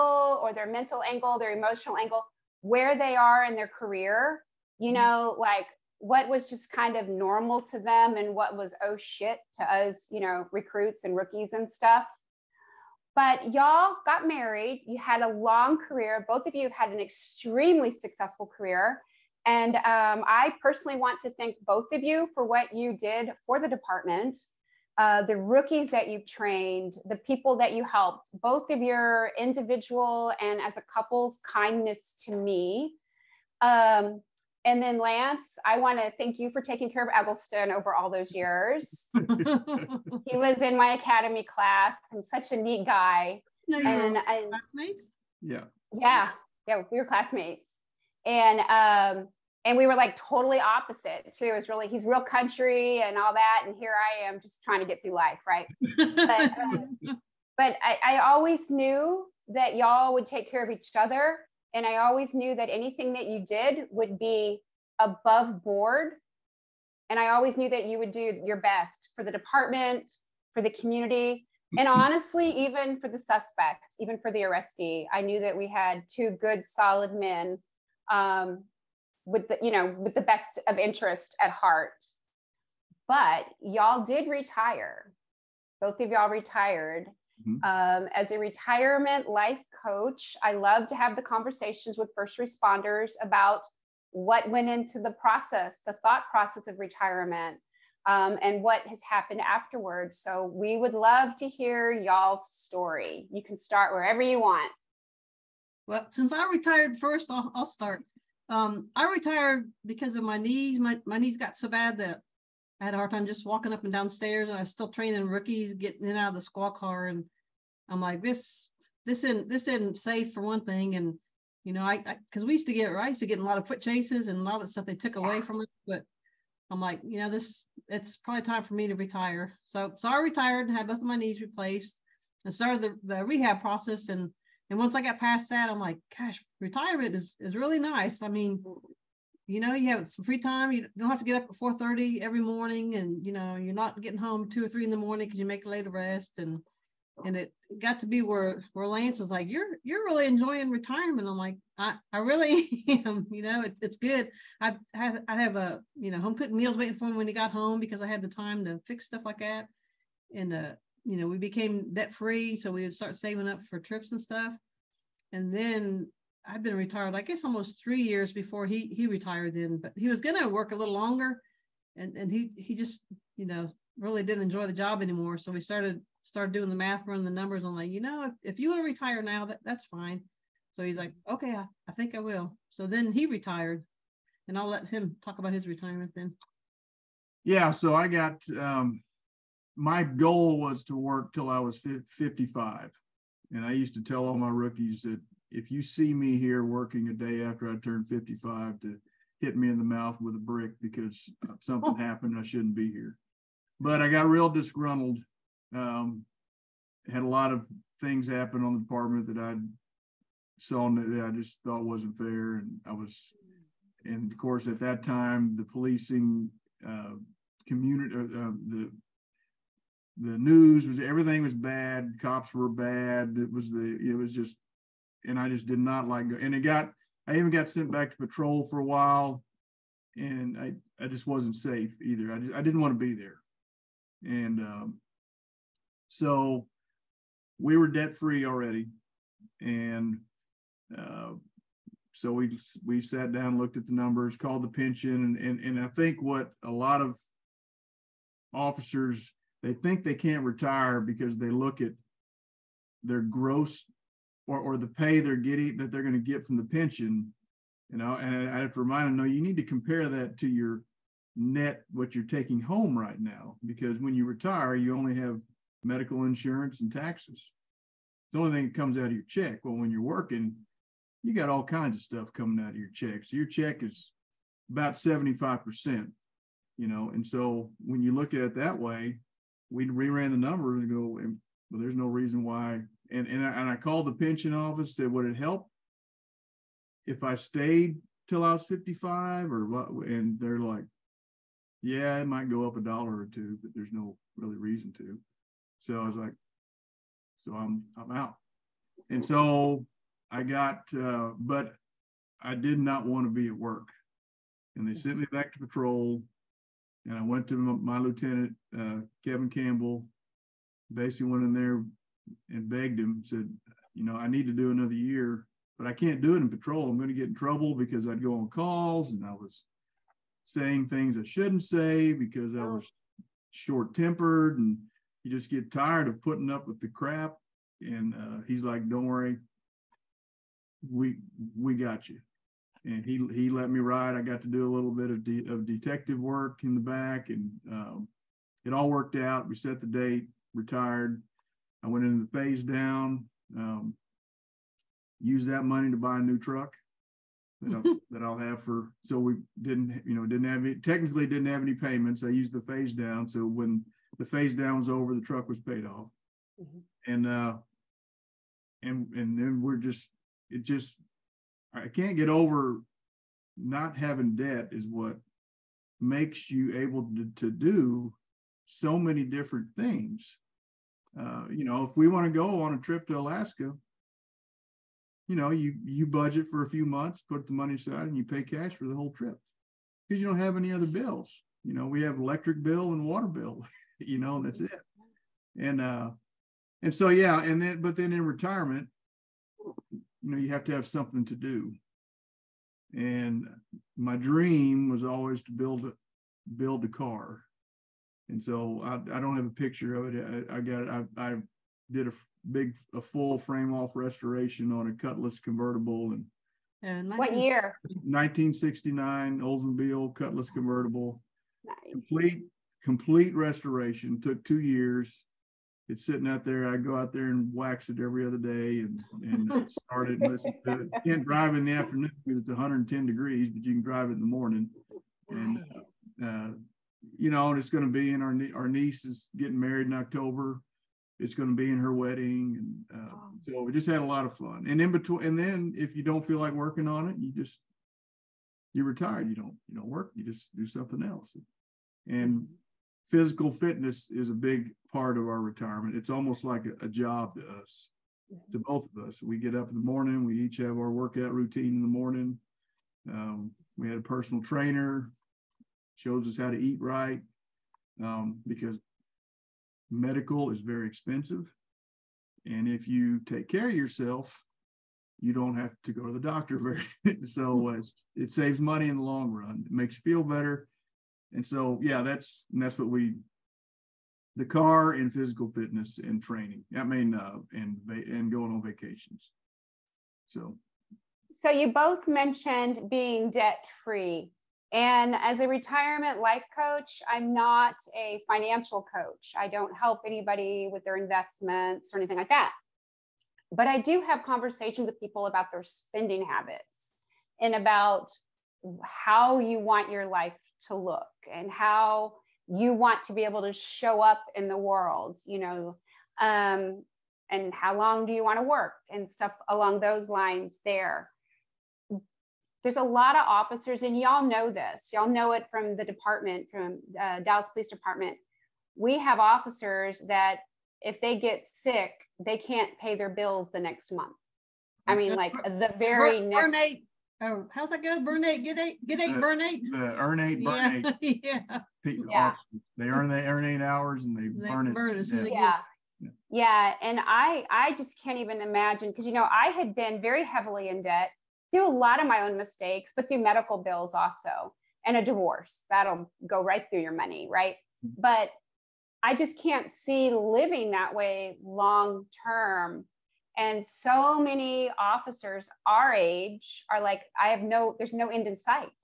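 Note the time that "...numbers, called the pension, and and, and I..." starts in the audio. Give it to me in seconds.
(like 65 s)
243 s.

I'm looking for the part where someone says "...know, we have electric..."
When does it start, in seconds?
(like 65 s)
381 s.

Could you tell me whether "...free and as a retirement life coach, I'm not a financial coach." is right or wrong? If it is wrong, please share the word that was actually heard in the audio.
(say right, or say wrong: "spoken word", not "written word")
right.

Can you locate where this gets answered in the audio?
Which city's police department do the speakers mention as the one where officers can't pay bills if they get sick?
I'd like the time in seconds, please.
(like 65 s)
517 s.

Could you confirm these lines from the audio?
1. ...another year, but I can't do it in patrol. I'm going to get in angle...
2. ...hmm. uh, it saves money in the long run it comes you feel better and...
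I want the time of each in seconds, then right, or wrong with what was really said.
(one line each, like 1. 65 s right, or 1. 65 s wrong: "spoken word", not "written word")
1. 314 s wrong: "trouble", not "angle"
2. 467 s wrong: "makes", not "comes".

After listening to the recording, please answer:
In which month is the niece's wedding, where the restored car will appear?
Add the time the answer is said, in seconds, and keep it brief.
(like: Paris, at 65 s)
October, at 429 s.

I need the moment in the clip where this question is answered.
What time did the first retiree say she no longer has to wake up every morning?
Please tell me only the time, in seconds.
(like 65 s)
141 s.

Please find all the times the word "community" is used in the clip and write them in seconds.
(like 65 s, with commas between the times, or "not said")
70 s, 217 s.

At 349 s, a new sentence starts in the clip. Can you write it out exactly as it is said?
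So we didn't, you know, didn't have any, technically didn't have any payments.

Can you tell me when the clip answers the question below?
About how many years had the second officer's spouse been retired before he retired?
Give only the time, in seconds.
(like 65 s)
167 s.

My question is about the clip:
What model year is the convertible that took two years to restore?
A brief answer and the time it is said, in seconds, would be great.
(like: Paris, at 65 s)
1969, at 407 s.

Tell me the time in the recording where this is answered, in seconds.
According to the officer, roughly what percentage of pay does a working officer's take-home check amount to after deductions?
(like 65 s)
274 s.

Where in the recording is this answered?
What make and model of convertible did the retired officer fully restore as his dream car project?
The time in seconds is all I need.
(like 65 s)
409 s.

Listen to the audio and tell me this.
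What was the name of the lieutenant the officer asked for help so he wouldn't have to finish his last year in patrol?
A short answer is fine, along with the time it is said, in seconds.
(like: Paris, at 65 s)
Kevin Campbell, at 309 s.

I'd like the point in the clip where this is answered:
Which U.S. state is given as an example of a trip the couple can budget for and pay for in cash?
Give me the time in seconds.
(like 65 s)
373 s.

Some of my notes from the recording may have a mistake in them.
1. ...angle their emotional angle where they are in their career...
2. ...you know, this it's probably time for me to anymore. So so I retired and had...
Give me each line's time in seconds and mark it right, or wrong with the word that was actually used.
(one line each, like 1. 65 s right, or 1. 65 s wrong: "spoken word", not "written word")
1. 1 s right
2. 127 s wrong: "retire", not "anymore".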